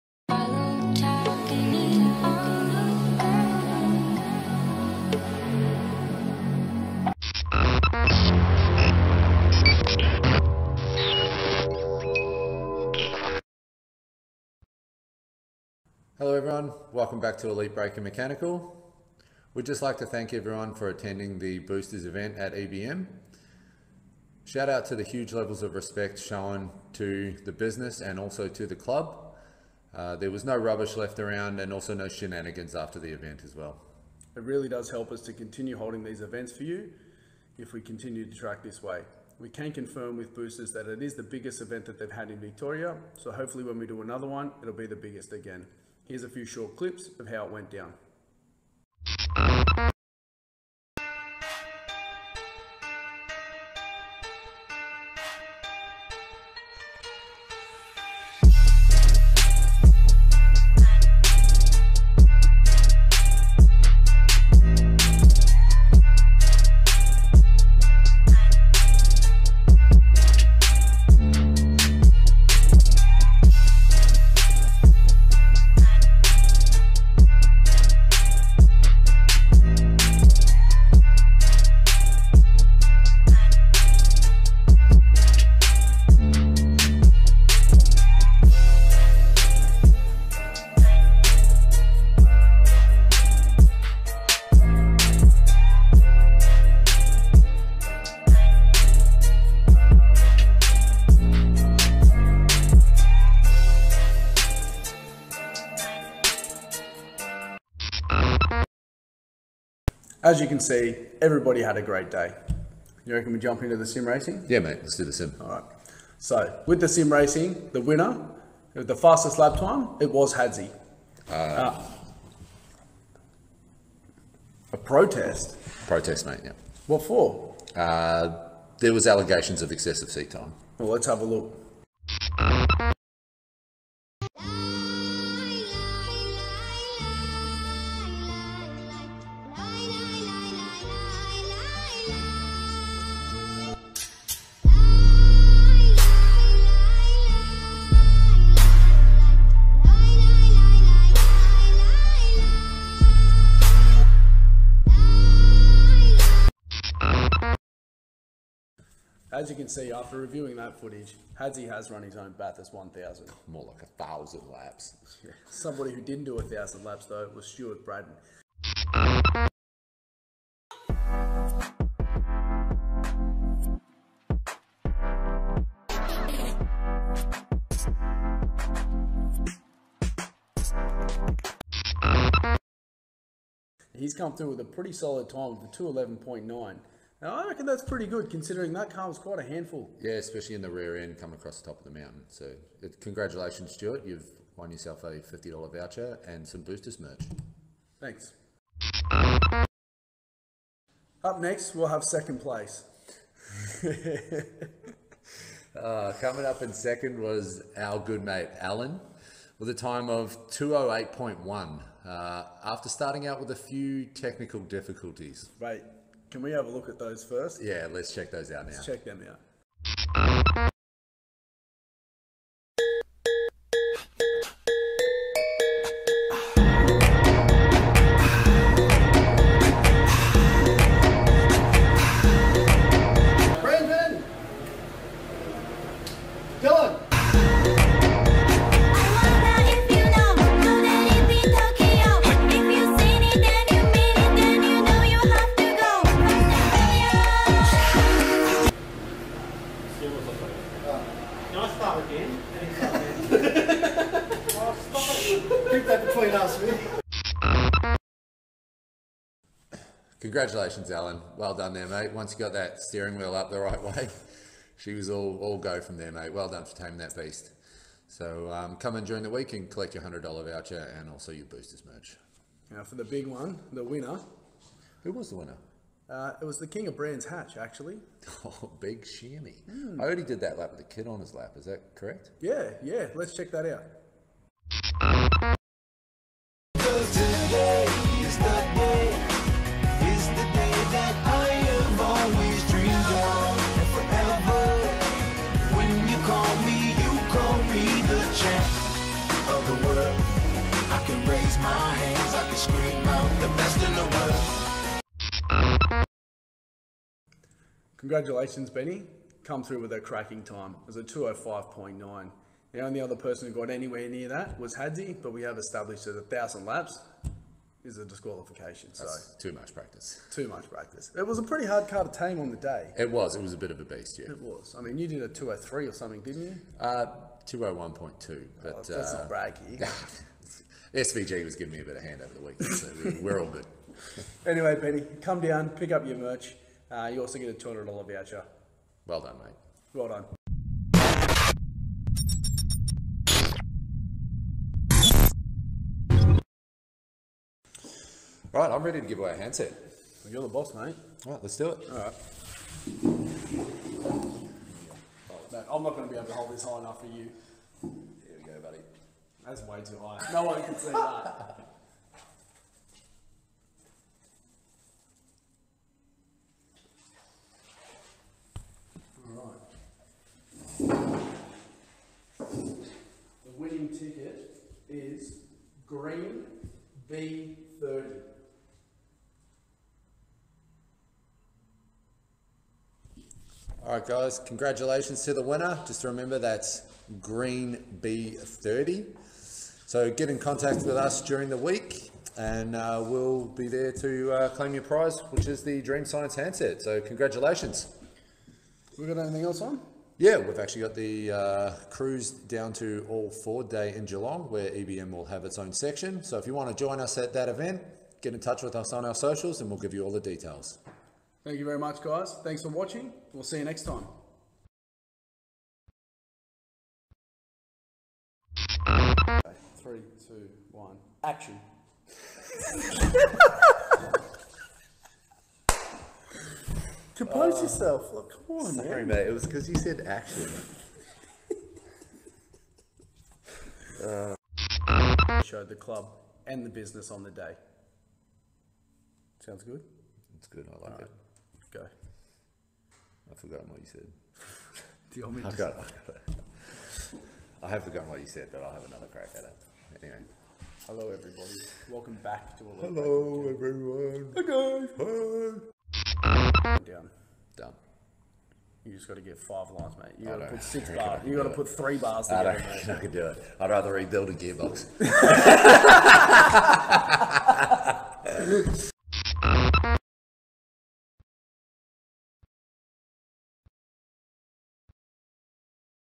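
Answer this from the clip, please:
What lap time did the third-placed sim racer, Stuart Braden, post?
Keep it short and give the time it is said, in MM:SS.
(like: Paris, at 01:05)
211.9, at 03:05.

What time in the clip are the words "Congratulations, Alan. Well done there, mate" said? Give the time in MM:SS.
04:20.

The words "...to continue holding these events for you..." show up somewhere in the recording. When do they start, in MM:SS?
00:35.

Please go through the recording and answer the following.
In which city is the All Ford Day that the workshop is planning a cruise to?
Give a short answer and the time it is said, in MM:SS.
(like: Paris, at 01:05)
Geelong, at 06:44.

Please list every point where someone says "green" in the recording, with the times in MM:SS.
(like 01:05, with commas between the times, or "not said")
06:15, 06:27.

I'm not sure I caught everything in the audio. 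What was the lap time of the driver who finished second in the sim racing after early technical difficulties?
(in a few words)
208.1.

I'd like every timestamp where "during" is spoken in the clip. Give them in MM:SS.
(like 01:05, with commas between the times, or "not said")
04:29, 06:31.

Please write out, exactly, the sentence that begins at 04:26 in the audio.
Well done for taming that beast.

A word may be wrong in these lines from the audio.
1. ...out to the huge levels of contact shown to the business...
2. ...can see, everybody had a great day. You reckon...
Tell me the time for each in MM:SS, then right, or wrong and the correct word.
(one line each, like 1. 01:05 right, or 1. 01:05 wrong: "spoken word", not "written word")
1. 00:24 wrong: "respect", not "contact"
2. 01:50 right.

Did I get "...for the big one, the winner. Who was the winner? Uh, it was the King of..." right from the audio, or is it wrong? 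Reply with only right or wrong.
right.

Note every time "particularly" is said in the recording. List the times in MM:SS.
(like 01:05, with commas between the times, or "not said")
not said.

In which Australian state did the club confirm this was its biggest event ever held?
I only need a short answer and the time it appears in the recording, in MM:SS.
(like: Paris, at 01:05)
Victoria, at 00:42.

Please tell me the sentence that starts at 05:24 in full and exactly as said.
I mean, you did a 203 or something, didn't you?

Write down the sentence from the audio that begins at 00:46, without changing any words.
Here's a few short clips of how it went down.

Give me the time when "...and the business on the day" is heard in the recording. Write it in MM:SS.
07:16.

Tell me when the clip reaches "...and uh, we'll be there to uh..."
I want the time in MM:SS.
06:32.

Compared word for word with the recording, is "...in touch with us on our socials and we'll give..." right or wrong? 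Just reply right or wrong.
right.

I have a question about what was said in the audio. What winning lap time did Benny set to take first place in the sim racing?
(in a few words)
205.9.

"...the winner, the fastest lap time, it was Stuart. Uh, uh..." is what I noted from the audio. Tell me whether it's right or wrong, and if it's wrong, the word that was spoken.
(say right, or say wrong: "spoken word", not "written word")
wrong: "Hadzi", not "Stuart".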